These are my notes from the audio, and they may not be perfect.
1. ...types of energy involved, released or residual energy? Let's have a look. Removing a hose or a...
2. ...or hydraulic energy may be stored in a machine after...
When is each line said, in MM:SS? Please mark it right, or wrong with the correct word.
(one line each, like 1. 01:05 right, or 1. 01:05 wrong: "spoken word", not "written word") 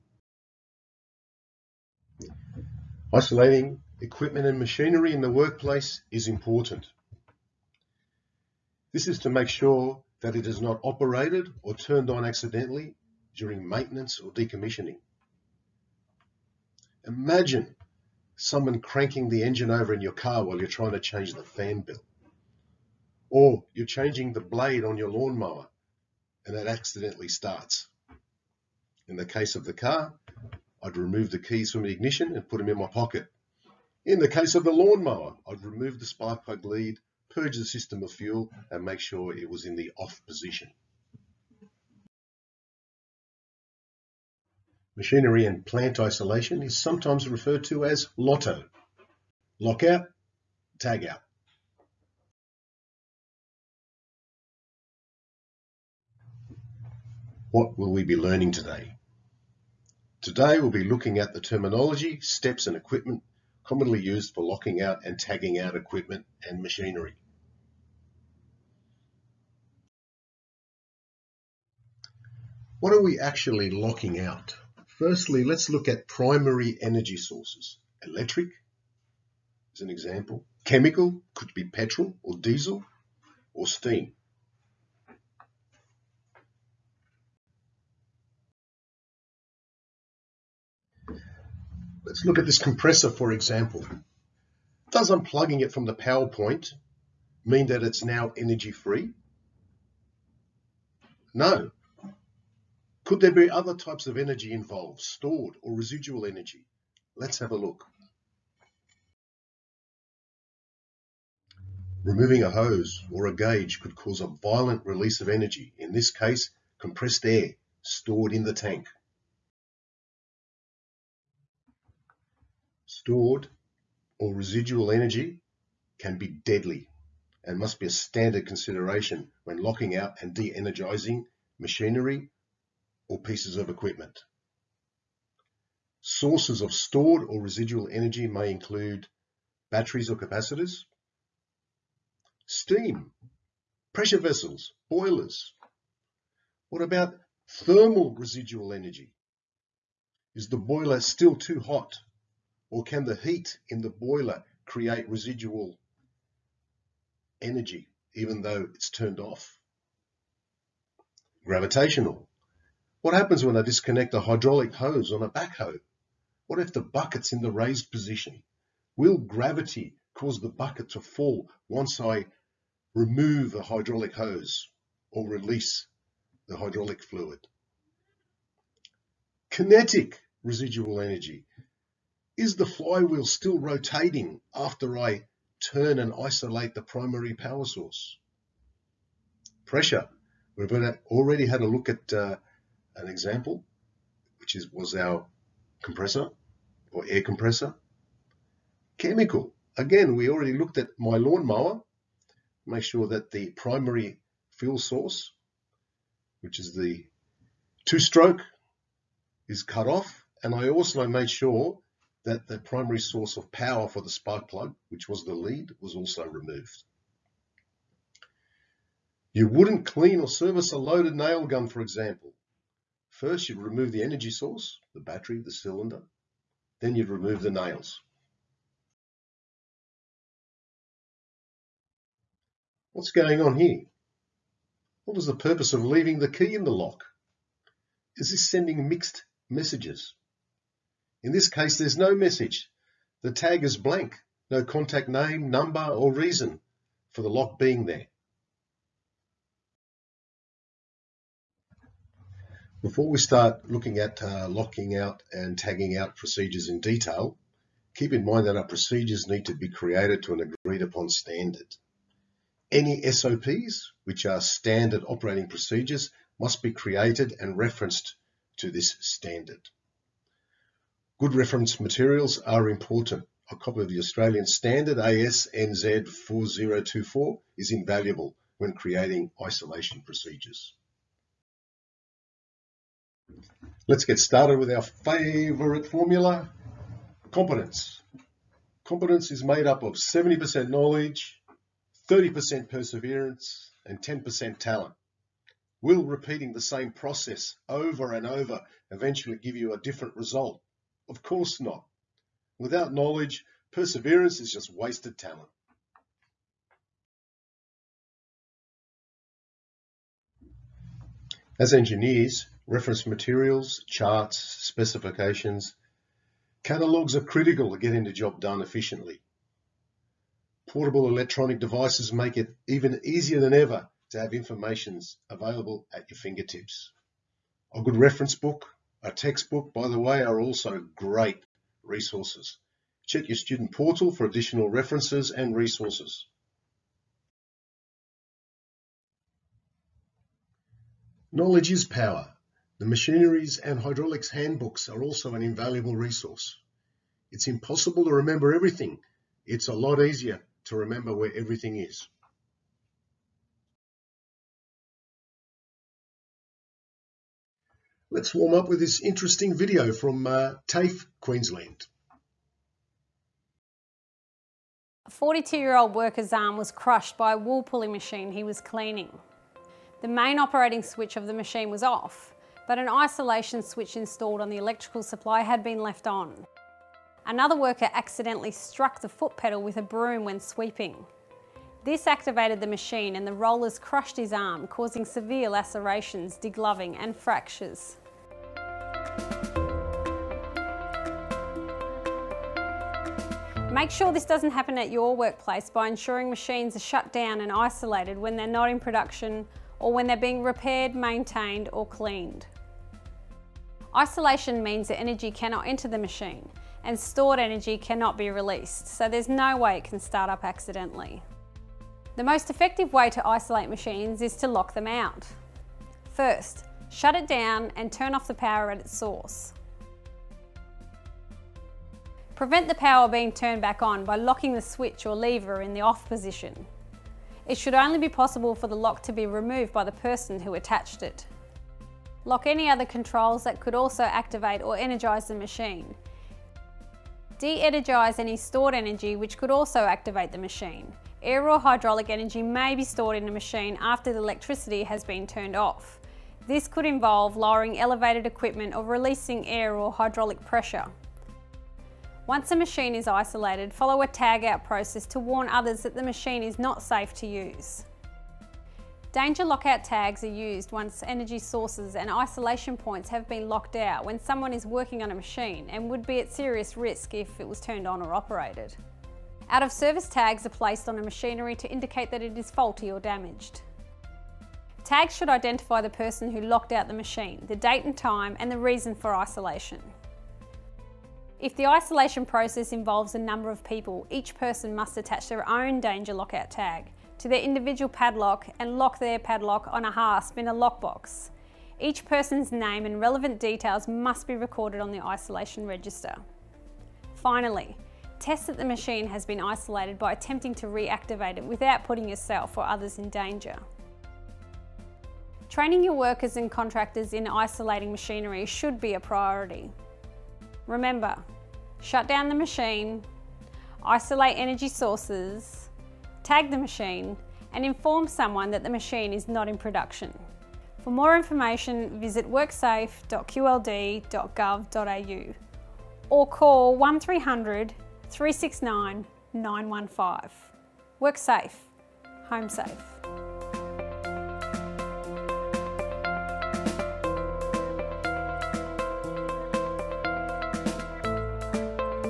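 1. 01:43 wrong: "stored", not "released"
2. 07:21 right.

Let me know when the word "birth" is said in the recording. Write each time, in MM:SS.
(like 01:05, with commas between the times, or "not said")
not said.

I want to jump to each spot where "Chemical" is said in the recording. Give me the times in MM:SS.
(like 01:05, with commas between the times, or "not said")
01:20, 03:18.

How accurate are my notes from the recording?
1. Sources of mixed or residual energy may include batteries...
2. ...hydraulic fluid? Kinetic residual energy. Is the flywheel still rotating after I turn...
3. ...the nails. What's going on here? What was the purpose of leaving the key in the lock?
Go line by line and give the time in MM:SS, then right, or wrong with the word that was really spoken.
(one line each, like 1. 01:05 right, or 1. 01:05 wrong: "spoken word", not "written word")
1. 02:16 wrong: "stored", not "mixed"
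2. 02:56 right
3. 03:47 right.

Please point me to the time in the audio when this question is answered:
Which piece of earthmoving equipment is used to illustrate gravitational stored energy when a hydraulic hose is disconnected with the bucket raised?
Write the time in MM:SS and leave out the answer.
02:45.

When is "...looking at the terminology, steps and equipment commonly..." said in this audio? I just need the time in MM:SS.
01:00.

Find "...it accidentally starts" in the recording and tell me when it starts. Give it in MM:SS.
00:26.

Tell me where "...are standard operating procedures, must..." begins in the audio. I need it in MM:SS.
04:24.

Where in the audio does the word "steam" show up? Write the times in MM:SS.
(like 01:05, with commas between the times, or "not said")
01:23, 02:22.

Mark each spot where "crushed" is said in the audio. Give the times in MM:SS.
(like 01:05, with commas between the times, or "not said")
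06:06, 06:23.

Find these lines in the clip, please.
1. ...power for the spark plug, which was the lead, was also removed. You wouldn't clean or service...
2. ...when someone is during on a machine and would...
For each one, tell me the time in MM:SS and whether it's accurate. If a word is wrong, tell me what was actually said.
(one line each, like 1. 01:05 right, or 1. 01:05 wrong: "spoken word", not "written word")
1. 03:33 right
2. 07:44 wrong: "working", not "during".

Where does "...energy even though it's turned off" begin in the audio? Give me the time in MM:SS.
02:37.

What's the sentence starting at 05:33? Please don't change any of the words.
Check your student portal for additional references and resources.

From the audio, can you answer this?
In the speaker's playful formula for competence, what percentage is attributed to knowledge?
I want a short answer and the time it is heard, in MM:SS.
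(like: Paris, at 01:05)
70%, at 04:49.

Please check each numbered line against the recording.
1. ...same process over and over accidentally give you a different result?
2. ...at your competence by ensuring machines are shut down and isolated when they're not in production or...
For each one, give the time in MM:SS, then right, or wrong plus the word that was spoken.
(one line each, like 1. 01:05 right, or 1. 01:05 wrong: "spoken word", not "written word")
1. 04:56 wrong: "eventually", not "accidentally"
2. 06:34 wrong: "workplace", not "competence".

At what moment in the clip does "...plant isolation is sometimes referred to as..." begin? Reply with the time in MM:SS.
00:45.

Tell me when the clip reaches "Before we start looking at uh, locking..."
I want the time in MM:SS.
04:12.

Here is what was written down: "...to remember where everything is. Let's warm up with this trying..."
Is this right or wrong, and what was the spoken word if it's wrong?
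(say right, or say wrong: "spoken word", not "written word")
wrong: "interesting", not "trying".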